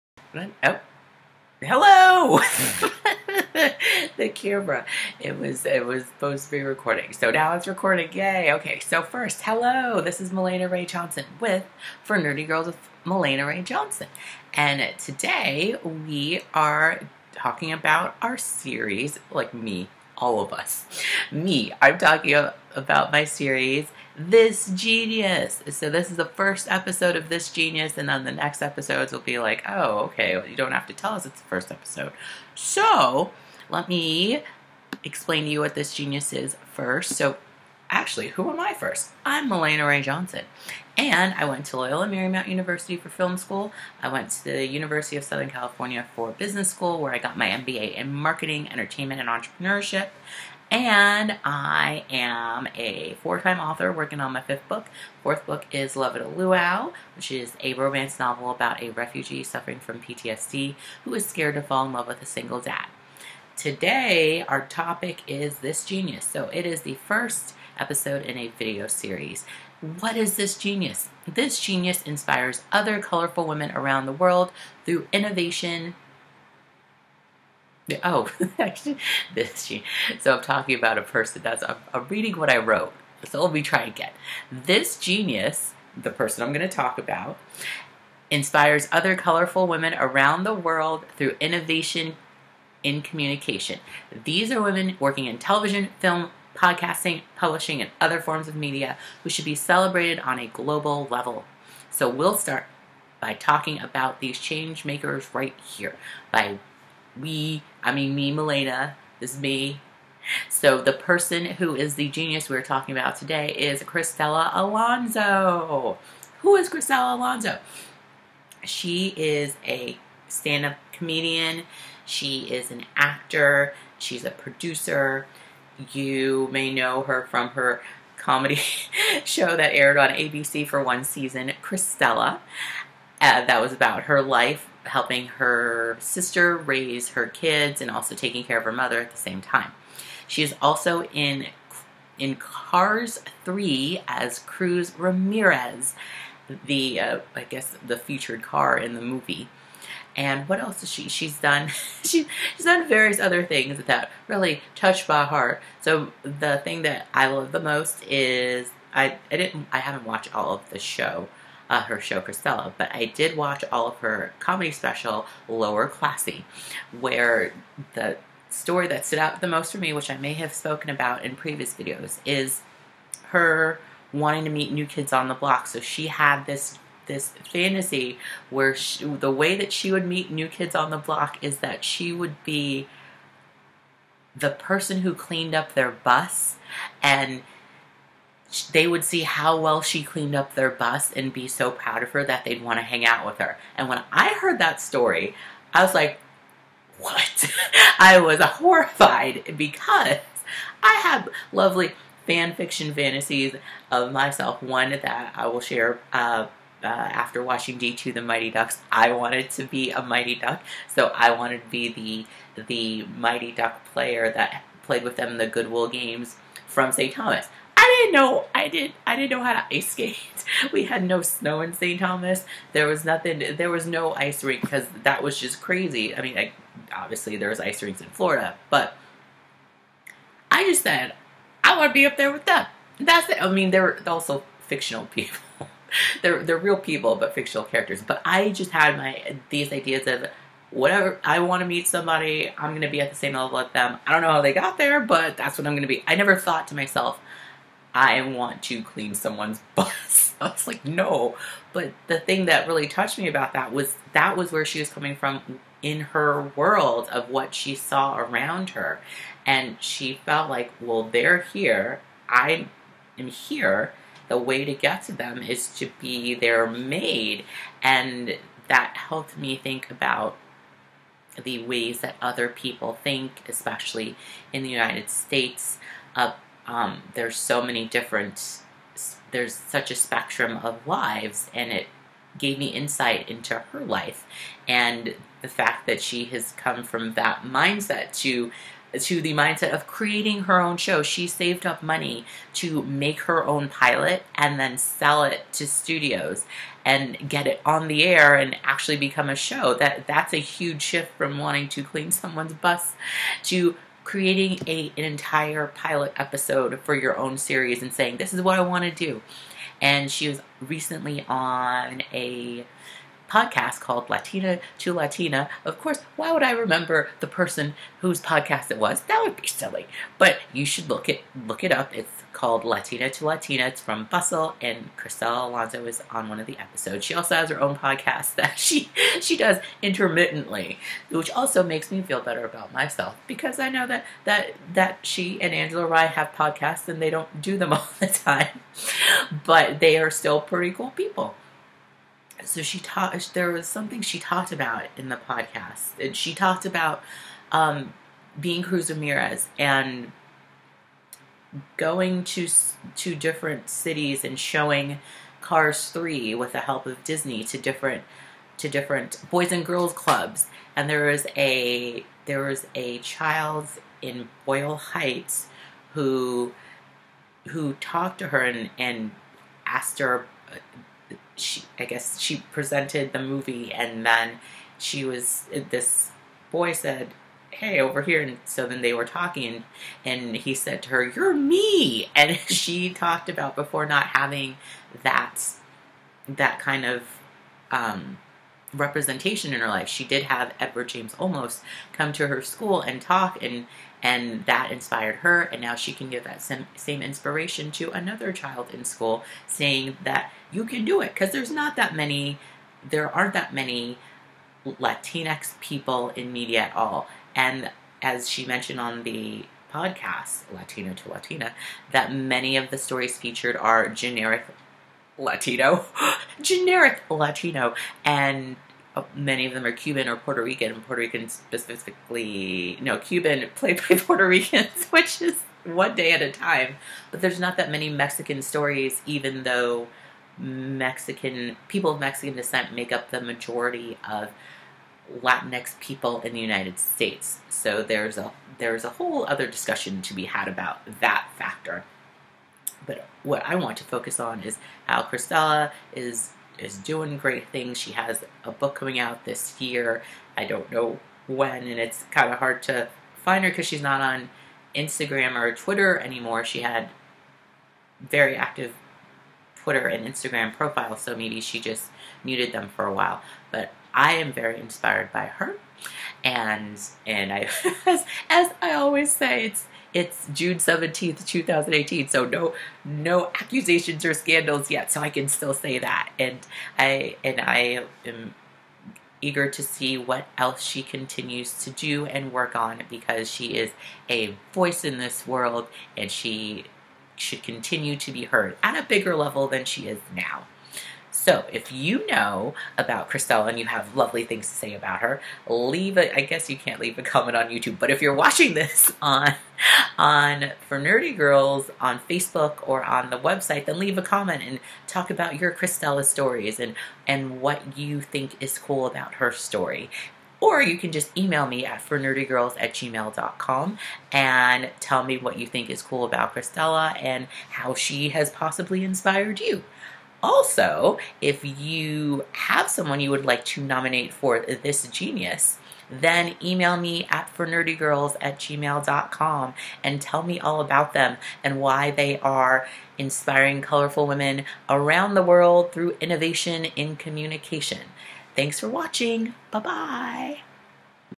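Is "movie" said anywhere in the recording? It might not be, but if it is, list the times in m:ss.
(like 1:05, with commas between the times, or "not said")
2:29, 6:13.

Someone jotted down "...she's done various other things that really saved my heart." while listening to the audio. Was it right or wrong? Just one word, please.
wrong.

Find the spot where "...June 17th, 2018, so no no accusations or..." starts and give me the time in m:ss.
7:50.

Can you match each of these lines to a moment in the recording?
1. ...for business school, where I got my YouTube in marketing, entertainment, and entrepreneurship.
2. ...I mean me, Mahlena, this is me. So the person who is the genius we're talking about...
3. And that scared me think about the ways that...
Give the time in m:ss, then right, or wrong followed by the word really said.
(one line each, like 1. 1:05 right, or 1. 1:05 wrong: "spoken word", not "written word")
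1. 0:46 wrong: "MBA", not "YouTube"
2. 1:47 right
3. 4:27 wrong: "helped", not "scared".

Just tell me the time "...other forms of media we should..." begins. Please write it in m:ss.
1:37.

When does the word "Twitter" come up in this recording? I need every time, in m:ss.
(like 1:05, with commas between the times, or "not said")
7:35, 7:39.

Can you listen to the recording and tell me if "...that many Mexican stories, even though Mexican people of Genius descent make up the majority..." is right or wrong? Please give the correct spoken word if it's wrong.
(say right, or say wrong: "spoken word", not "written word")
wrong: "Mexican", not "Genius".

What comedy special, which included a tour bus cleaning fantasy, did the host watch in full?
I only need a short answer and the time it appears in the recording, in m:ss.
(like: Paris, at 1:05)
Lower Classy, at 2:45.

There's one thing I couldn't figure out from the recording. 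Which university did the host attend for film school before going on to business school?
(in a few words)
Loyola Marymount University.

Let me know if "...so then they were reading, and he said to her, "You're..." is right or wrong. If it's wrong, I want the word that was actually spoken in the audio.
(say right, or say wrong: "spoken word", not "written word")
wrong: "talking", not "reading".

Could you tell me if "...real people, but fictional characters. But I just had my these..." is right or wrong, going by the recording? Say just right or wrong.
right.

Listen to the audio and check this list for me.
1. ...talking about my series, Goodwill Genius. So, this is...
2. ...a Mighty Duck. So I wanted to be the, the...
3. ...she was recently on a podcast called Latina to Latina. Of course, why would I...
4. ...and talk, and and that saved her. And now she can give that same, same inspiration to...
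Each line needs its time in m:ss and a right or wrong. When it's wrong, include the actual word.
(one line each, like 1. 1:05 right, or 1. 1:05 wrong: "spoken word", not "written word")
1. 0:21 wrong: "This", not "Goodwill"
2. 3:29 right
3. 5:10 right
4. 6:32 wrong: "inspired", not "saved".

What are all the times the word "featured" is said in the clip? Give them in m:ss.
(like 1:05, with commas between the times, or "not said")
2:27, 6:53.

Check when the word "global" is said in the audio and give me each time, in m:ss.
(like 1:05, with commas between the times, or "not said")
1:40.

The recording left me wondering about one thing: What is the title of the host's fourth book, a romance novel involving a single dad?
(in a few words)
Love at a Luau.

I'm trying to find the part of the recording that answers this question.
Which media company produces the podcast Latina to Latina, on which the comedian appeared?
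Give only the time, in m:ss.
5:24.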